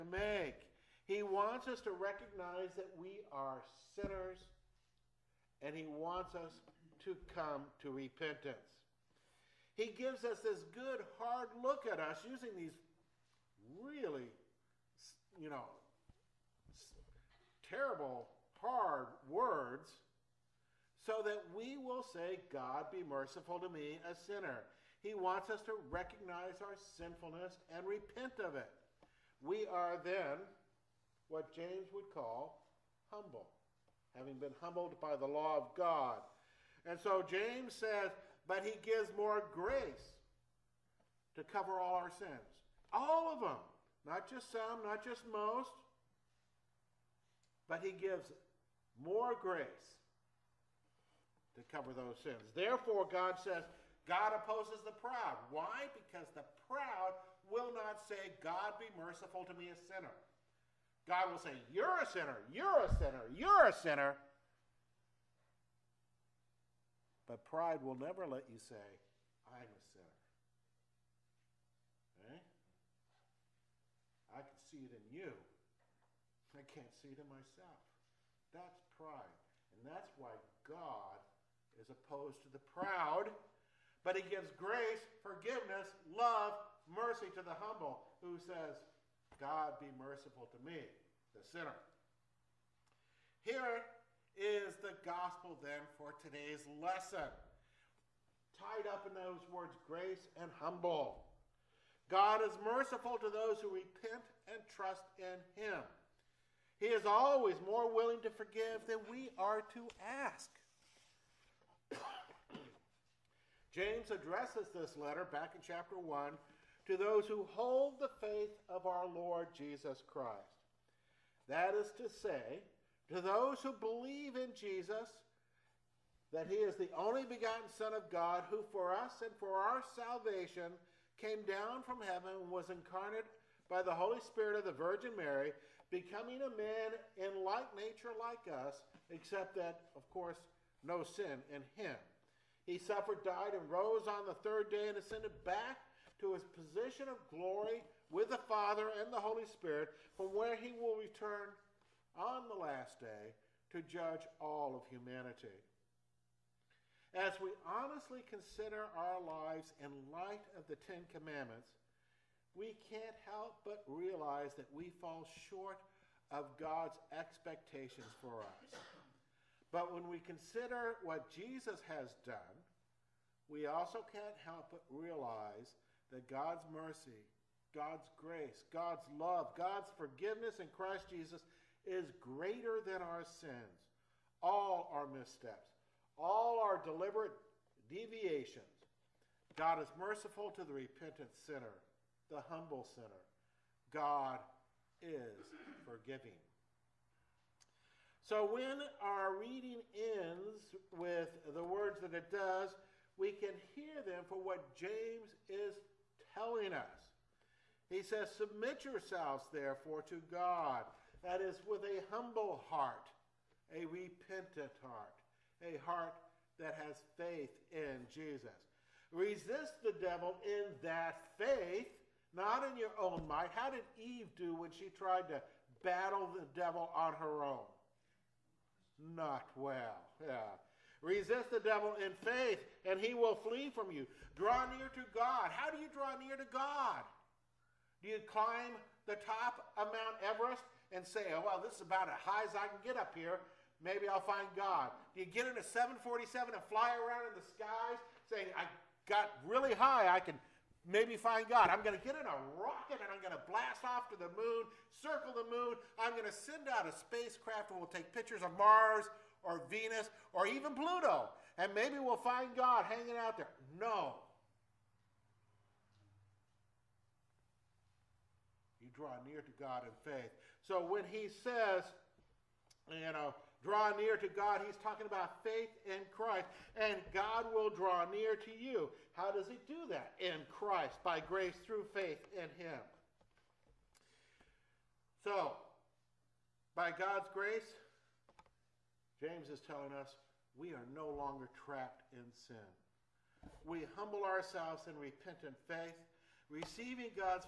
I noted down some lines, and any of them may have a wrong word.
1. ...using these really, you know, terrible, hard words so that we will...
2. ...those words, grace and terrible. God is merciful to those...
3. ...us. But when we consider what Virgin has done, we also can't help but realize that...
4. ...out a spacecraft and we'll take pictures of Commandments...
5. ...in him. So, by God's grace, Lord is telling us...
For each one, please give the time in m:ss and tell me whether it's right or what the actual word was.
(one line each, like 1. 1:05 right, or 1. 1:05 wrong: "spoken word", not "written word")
1. 0:12 right
2. 1:39 wrong: "humble", not "terrible"
3. 2:48 wrong: "Jesus", not "Virgin"
4. 4:16 wrong: "Mars", not "Commandments"
5. 4:42 wrong: "James", not "Lord".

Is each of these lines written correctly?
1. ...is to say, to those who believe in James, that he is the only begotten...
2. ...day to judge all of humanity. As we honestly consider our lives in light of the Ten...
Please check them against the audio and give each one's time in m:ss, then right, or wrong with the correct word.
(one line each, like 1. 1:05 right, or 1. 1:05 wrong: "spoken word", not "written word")
1. 2:01 wrong: "Jesus", not "James"
2. 2:33 right.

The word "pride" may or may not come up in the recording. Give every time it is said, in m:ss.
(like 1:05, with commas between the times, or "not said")
1:07, 1:18.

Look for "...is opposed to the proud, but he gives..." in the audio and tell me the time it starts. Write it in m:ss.
1:21.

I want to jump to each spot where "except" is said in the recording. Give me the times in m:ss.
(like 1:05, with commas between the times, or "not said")
2:19.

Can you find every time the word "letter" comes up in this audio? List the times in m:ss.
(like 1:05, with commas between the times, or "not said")
1:55.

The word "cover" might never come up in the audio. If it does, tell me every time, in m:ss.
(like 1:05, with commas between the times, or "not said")
0:41, 0:51.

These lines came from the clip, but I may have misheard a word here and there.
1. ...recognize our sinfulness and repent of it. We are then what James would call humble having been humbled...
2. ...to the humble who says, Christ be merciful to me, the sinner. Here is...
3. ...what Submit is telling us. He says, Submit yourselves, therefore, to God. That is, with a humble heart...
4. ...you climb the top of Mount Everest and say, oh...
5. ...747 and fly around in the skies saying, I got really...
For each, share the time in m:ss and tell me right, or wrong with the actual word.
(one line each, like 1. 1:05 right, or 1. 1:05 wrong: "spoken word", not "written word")
1. 0:25 right
2. 1:27 wrong: "God", not "Christ"
3. 3:24 wrong: "James", not "Submit"
4. 3:58 right
5. 4:05 right.